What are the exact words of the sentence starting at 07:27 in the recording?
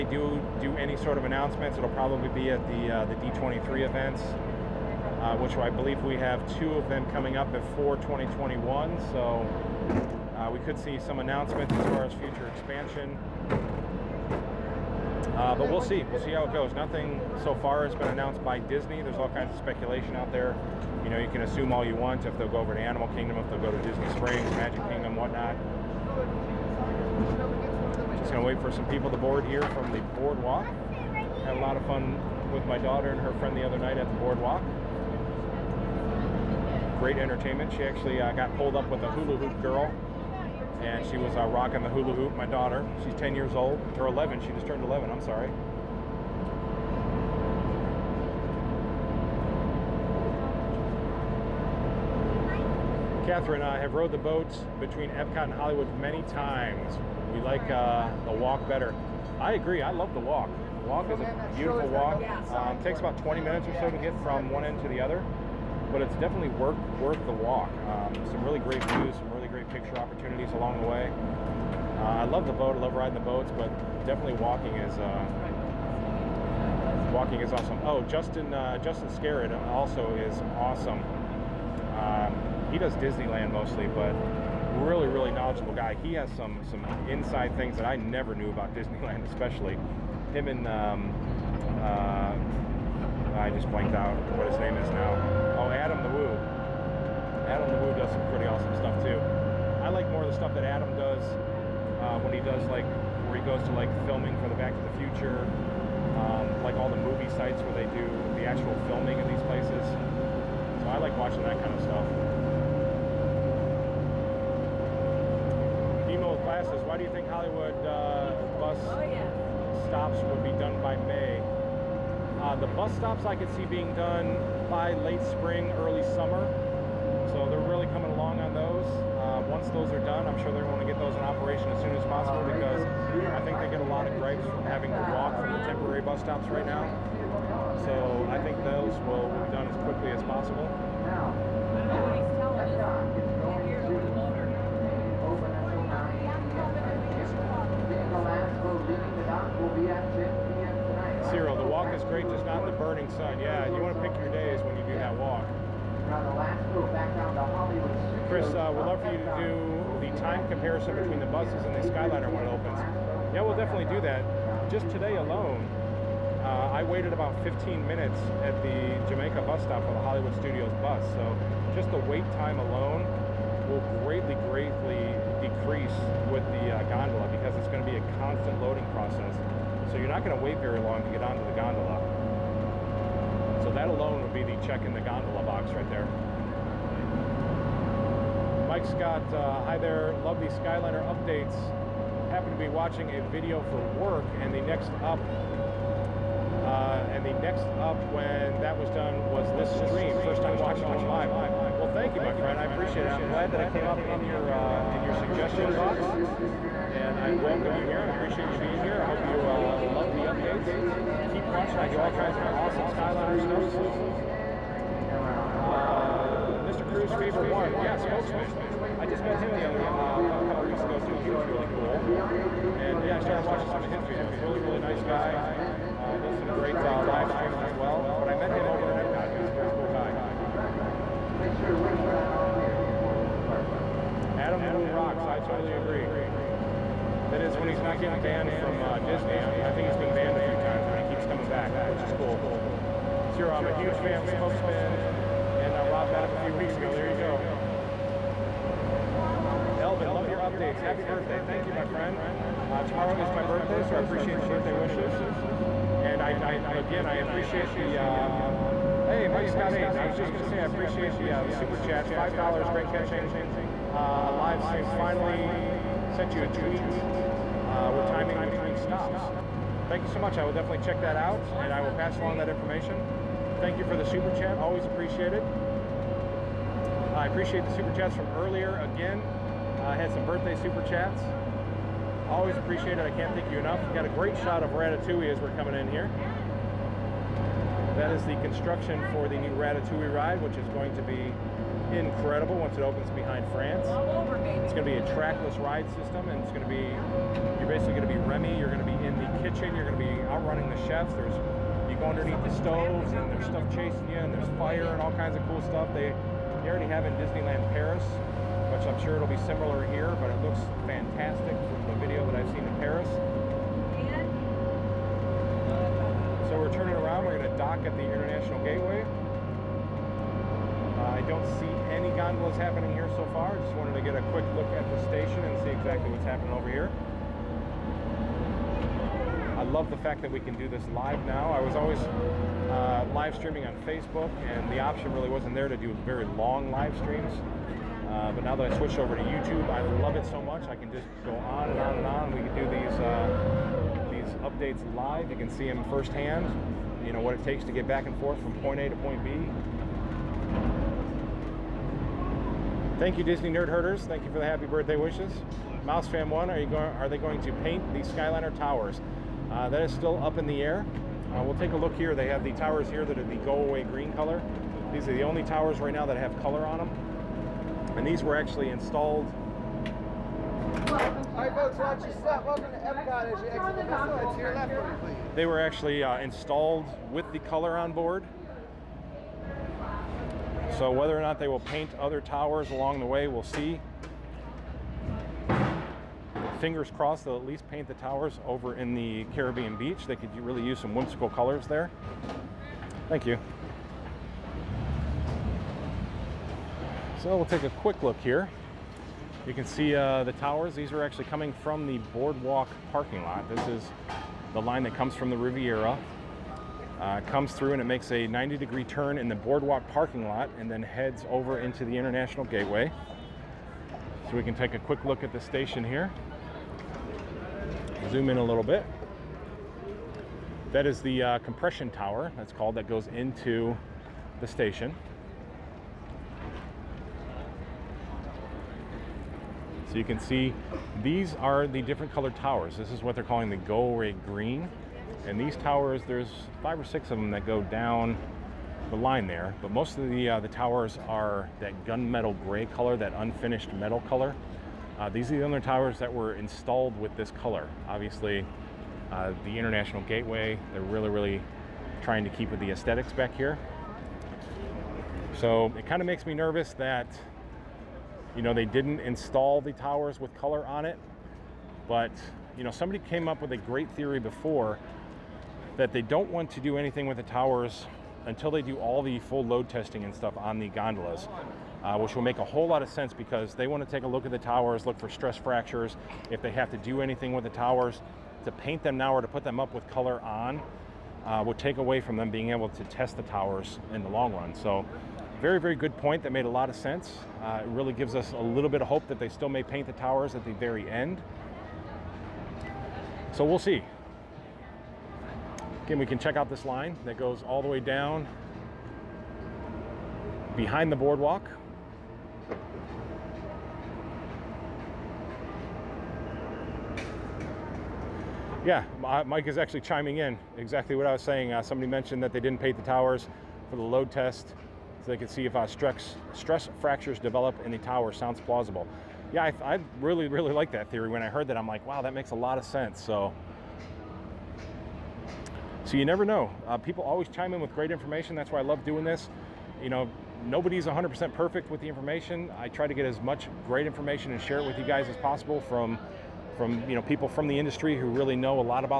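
Obviously, uh, the International Gateway, they're really, really trying to keep with the aesthetics back here.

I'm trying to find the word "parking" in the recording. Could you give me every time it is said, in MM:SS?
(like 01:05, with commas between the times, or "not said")
06:42, 06:49.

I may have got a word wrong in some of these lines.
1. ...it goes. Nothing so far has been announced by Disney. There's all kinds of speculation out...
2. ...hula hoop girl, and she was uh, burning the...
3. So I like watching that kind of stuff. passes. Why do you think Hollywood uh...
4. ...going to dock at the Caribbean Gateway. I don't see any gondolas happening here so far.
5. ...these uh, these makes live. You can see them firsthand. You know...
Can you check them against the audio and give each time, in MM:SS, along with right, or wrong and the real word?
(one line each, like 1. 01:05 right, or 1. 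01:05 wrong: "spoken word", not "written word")
1. 00:16 right
2. 00:39 wrong: "rocking", not "burning"
3. 01:49 right
4. 05:17 wrong: "International", not "Caribbean"
5. 05:42 wrong: "updates", not "makes".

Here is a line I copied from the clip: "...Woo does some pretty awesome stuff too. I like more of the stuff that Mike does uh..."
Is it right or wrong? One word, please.
wrong.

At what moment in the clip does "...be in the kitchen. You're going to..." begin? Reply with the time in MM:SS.
04:58.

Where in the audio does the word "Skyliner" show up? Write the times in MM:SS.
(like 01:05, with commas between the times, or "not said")
02:41, 03:10, 03:32, 05:58.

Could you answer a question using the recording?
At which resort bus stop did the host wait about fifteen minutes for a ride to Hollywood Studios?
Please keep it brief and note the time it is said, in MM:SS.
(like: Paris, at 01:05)
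Jamaica, at 02:49.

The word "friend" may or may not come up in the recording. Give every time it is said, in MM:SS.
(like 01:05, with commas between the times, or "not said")
00:33, 03:22, 04:11.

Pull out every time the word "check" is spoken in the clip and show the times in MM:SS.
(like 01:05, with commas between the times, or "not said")
03:04, 04:30, 08:16.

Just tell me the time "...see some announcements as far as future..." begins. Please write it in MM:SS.
00:10.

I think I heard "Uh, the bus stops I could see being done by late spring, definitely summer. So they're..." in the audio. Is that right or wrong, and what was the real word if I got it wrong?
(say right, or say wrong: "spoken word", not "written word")
wrong: "early", not "definitely".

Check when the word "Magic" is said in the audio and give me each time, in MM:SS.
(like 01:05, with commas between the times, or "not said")
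00:24.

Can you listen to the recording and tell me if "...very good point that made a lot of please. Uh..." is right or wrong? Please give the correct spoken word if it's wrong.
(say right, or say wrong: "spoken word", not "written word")
wrong: "sense", not "please".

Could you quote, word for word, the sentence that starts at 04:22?
Five dollars, great catching uh, a live stream.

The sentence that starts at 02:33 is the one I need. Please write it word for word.
Yeah, you want to pick your days when you do that walk.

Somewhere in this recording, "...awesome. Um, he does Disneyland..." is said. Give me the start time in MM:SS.
01:20.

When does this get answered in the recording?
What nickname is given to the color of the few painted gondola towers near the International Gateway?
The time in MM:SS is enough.
06:03.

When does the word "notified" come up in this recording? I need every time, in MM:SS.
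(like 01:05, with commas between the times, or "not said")
not said.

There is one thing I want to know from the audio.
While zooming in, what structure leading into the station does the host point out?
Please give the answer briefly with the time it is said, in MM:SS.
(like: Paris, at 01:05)
compression tower, at 07:01.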